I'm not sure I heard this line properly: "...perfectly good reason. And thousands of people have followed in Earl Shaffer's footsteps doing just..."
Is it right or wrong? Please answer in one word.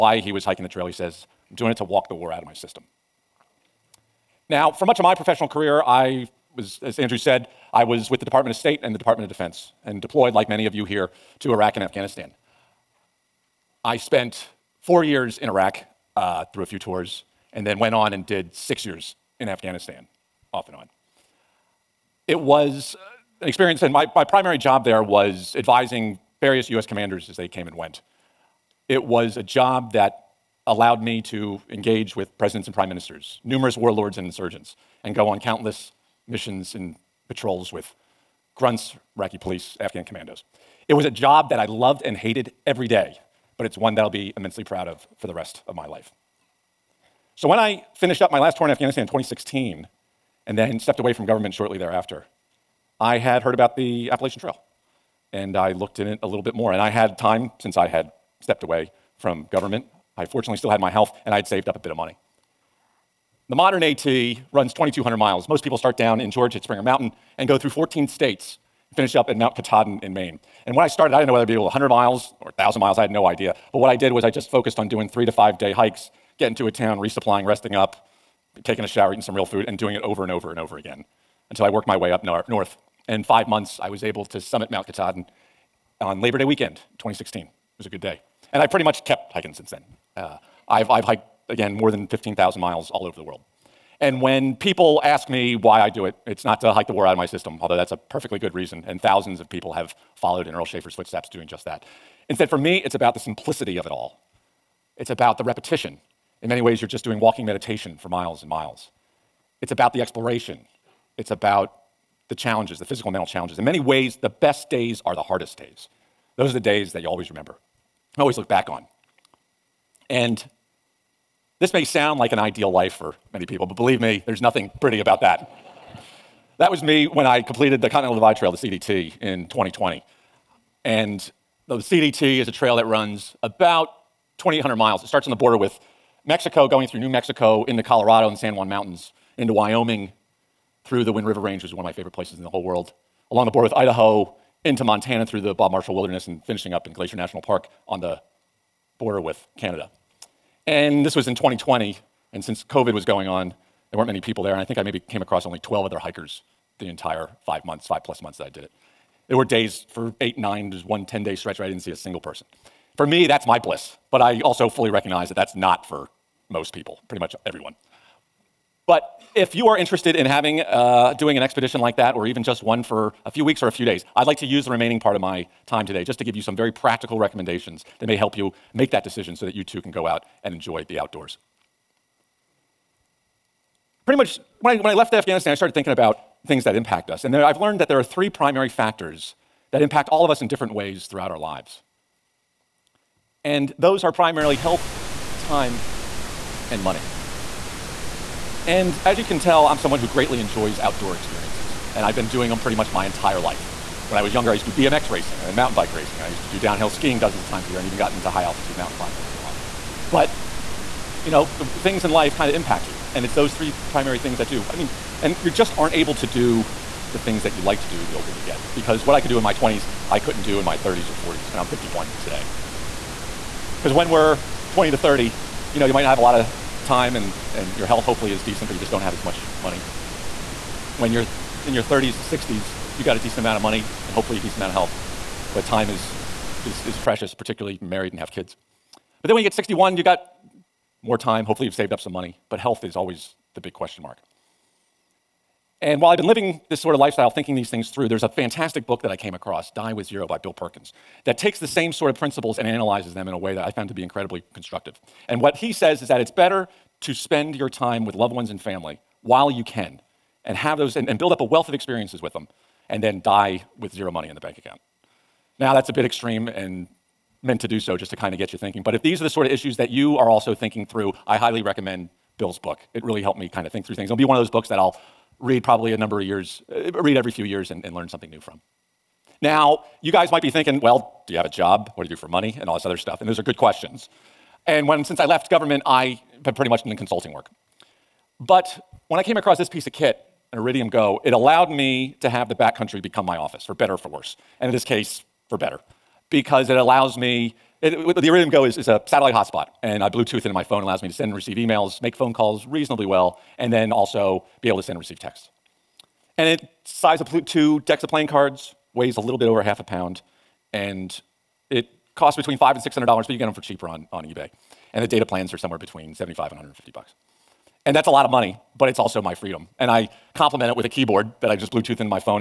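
right.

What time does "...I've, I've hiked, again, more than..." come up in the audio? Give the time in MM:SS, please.
01:30.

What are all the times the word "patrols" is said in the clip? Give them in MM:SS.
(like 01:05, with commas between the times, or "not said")
00:37.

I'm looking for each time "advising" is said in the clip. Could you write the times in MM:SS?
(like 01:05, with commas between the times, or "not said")
00:25.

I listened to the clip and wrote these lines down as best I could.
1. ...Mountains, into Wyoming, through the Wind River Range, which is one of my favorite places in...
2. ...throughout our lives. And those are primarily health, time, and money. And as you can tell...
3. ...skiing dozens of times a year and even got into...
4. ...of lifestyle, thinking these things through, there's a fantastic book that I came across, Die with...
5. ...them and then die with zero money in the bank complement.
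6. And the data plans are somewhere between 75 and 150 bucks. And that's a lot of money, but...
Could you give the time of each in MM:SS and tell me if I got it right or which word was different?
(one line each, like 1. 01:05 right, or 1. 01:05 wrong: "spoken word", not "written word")
1. 02:18 right
2. 03:11 right
3. 03:26 right
4. 04:06 right
5. 04:22 wrong: "account", not "complement"
6. 05:14 right.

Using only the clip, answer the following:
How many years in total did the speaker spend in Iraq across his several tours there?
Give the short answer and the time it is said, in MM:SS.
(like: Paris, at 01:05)
4, at 00:14.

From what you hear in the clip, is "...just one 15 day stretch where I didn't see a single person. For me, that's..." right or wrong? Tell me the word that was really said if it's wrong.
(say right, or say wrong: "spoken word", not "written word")
wrong: "10", not "15".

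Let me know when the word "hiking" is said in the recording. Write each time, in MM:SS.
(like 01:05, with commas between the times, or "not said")
00:00, 01:29.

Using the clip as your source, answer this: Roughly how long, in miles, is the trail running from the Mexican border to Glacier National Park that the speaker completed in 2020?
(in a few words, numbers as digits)
2,800 miles.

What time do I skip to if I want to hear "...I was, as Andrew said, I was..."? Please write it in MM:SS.
00:05.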